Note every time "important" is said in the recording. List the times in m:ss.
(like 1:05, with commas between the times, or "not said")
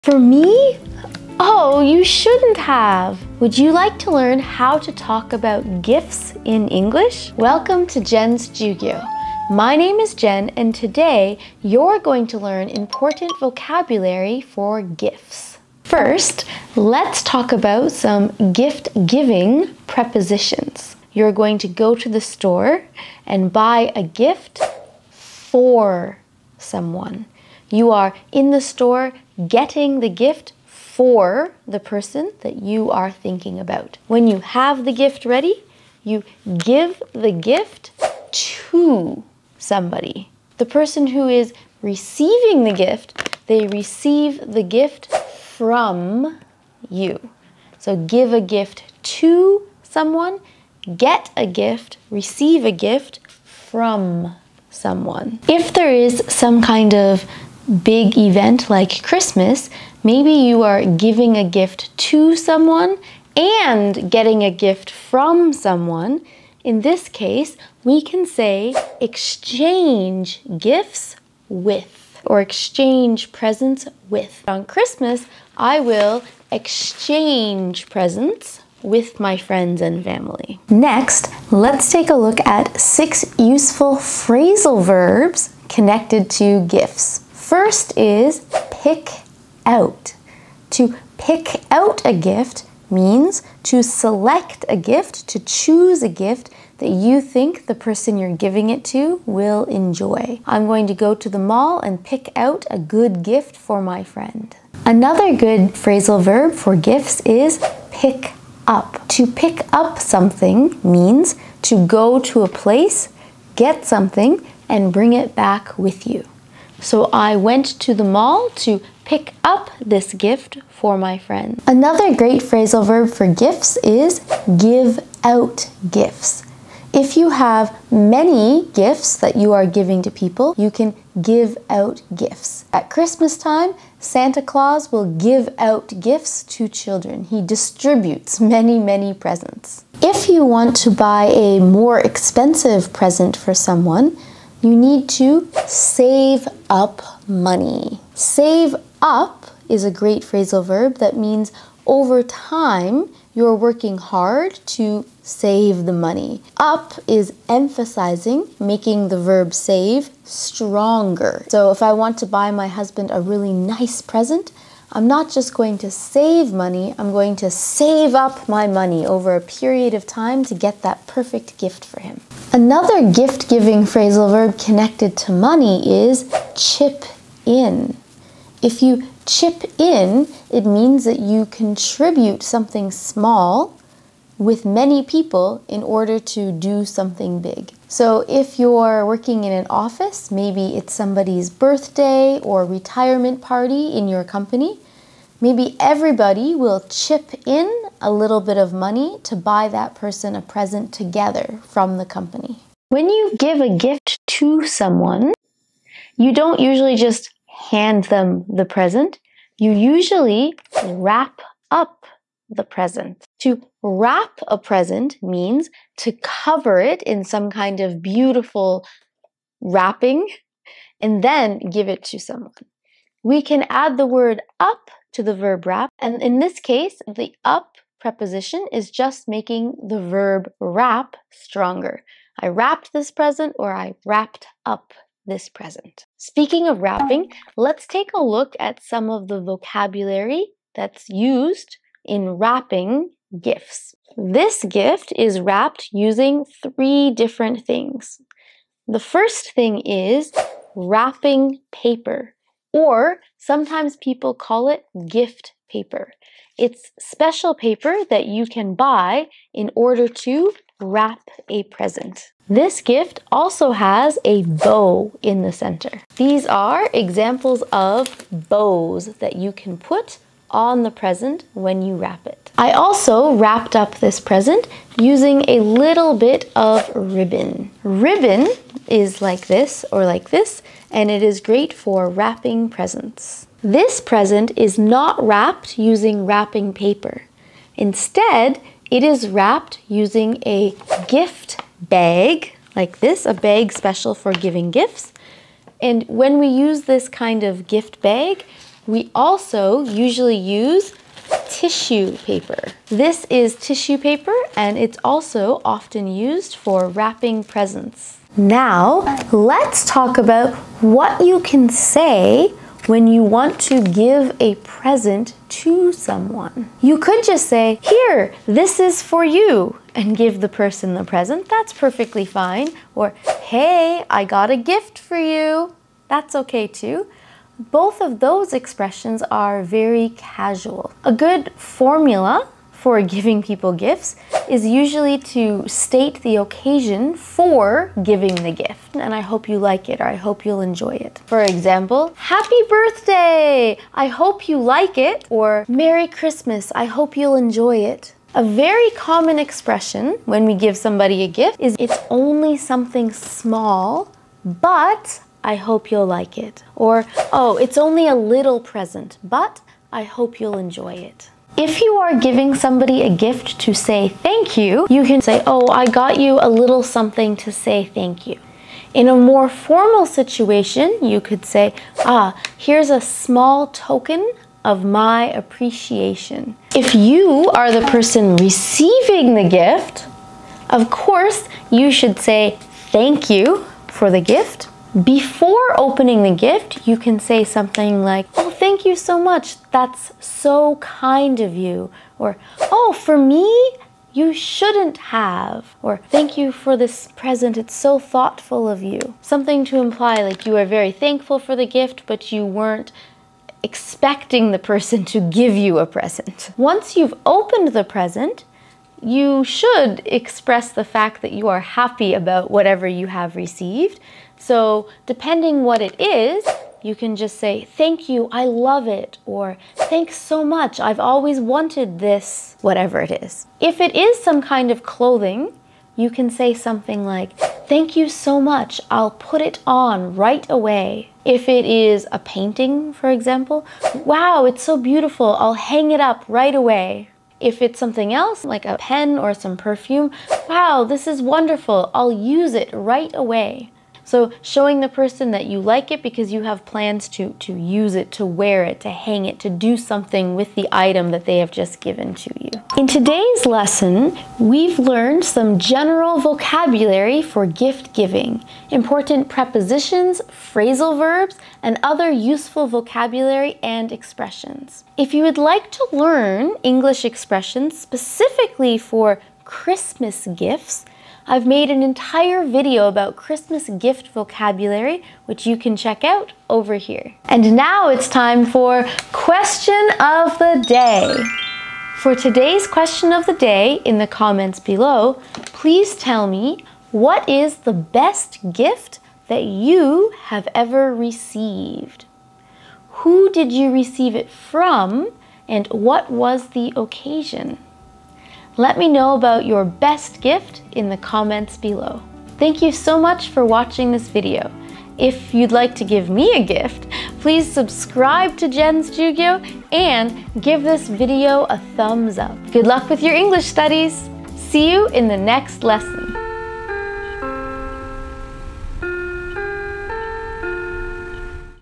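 0:12, 7:38.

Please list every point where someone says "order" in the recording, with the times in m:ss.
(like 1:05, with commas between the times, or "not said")
3:05, 4:19.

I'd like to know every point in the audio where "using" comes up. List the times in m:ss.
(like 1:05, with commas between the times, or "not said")
4:05, 4:34, 4:45, 4:49.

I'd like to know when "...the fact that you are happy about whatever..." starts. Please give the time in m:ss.
6:50.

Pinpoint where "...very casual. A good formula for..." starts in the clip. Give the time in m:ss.
5:29.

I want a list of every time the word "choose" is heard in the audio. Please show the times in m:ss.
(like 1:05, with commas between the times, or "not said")
1:35.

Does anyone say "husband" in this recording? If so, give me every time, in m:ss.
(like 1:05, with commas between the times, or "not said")
2:42.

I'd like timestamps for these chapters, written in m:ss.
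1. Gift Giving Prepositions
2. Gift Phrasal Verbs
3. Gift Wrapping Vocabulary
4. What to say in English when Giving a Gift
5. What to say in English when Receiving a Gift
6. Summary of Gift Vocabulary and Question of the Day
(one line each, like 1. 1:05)
1. 0:16
2. 1:22
3. 3:57
4. 5:10
5. 6:18
6. 7:33.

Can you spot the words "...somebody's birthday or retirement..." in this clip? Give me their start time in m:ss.
3:10.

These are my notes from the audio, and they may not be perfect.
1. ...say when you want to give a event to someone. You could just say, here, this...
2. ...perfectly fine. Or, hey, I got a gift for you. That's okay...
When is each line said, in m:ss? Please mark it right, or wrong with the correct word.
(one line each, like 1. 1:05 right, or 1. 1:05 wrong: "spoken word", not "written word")
1. 5:11 wrong: "present", not "event"
2. 5:21 right.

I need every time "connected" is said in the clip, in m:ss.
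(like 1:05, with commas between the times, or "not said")
1:25, 2:54.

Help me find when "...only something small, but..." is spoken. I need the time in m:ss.
5:52.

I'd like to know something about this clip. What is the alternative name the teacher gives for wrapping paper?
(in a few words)
gift paper.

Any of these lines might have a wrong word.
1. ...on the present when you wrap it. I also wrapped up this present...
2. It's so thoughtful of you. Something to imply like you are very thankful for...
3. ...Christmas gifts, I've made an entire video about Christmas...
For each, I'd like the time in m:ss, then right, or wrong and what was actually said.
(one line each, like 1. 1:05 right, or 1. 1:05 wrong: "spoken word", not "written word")
1. 4:30 right
2. 6:37 right
3. 7:49 right.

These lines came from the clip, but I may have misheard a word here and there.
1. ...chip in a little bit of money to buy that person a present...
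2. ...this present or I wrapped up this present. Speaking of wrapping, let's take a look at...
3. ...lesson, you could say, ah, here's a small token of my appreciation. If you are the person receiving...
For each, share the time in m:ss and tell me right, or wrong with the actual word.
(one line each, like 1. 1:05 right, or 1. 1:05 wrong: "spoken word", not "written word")
1. 3:16 right
2. 3:52 right
3. 6:10 wrong: "situation", not "lesson".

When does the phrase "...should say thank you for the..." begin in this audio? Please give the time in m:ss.
6:21.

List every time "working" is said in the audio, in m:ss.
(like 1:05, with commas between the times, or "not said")
2:33, 3:09.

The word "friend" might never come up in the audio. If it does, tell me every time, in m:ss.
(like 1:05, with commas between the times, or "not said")
1:19, 1:44, 2:01.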